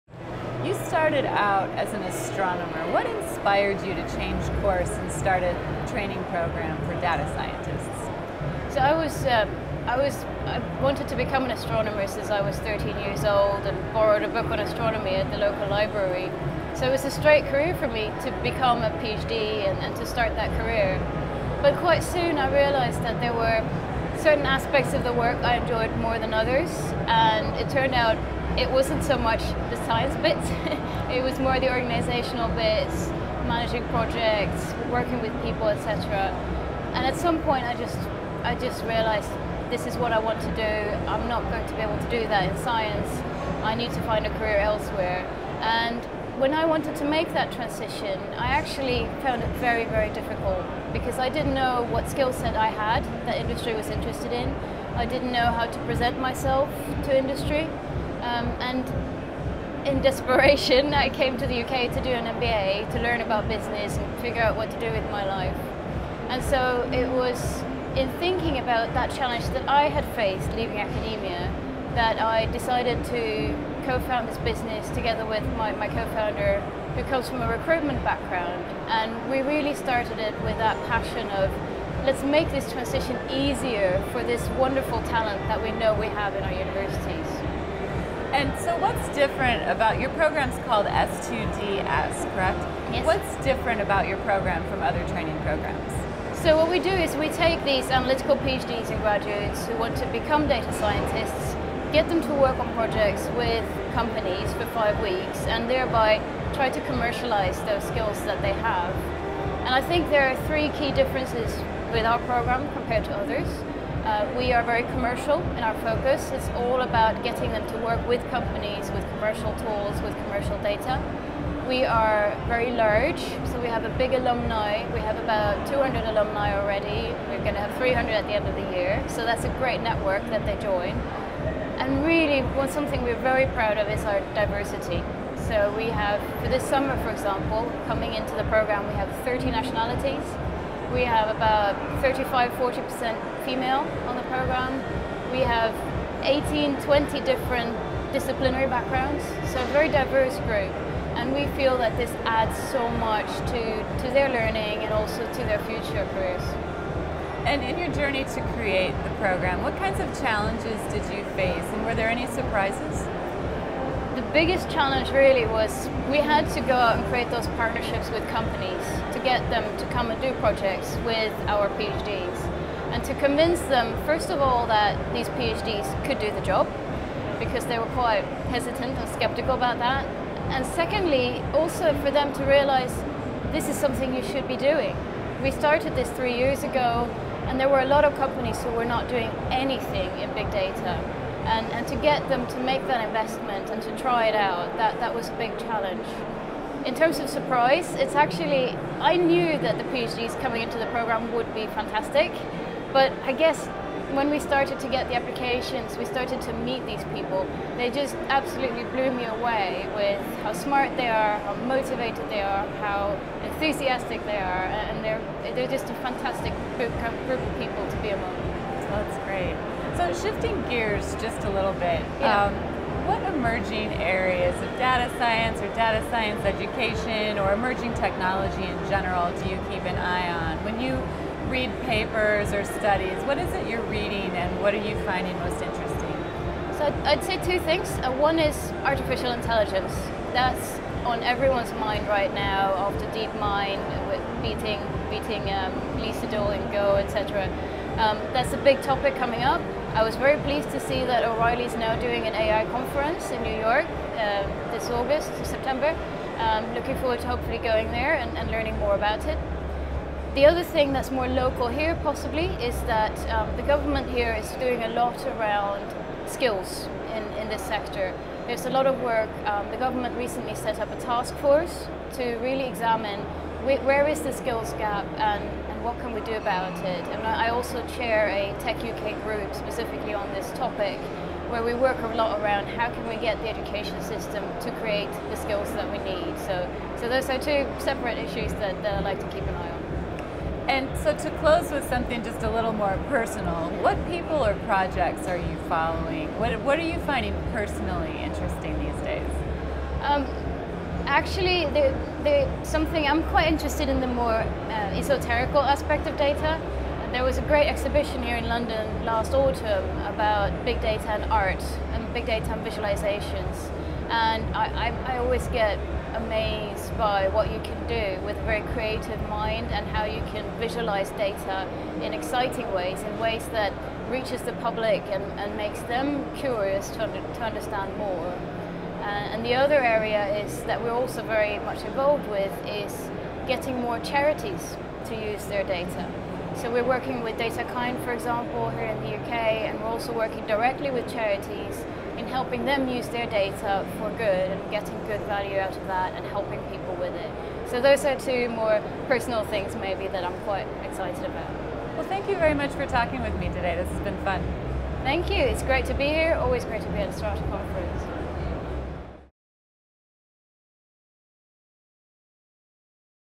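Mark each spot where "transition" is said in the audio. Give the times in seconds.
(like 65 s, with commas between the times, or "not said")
47 s, 82 s.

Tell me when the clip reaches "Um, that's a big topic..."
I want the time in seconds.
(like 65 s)
247 s.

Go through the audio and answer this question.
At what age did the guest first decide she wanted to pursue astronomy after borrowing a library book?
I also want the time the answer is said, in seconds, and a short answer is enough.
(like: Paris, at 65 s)
13, at 12 s.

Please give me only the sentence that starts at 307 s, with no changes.
There was a great exhibition here in London last autumn about big data and art and big data and visualizations.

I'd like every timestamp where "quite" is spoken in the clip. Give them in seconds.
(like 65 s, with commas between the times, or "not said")
21 s, 177 s, 303 s, 350 s.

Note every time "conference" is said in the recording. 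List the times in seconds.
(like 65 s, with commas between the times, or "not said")
252 s, 357 s.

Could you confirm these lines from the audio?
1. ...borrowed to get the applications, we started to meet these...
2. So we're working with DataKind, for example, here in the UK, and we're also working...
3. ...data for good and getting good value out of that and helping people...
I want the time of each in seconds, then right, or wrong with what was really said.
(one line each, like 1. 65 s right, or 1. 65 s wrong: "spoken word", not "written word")
1. 204 s wrong: "started", not "borrowed"
2. 336 s right
3. 343 s right.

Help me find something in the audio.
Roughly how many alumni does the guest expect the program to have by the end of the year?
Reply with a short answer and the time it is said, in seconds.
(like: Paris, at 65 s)
300, at 127 s.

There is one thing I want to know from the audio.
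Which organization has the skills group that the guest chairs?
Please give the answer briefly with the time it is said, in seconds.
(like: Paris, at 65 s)
Tech UK, at 278 s.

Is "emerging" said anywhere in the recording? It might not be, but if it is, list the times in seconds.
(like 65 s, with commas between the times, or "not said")
223 s, 227 s.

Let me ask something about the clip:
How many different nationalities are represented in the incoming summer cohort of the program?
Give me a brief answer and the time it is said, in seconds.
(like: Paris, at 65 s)
30, at 139 s.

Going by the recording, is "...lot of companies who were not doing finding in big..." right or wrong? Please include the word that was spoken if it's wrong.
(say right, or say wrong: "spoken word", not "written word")
wrong: "anything", not "finding".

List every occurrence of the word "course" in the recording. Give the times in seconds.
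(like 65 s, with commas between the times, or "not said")
4 s.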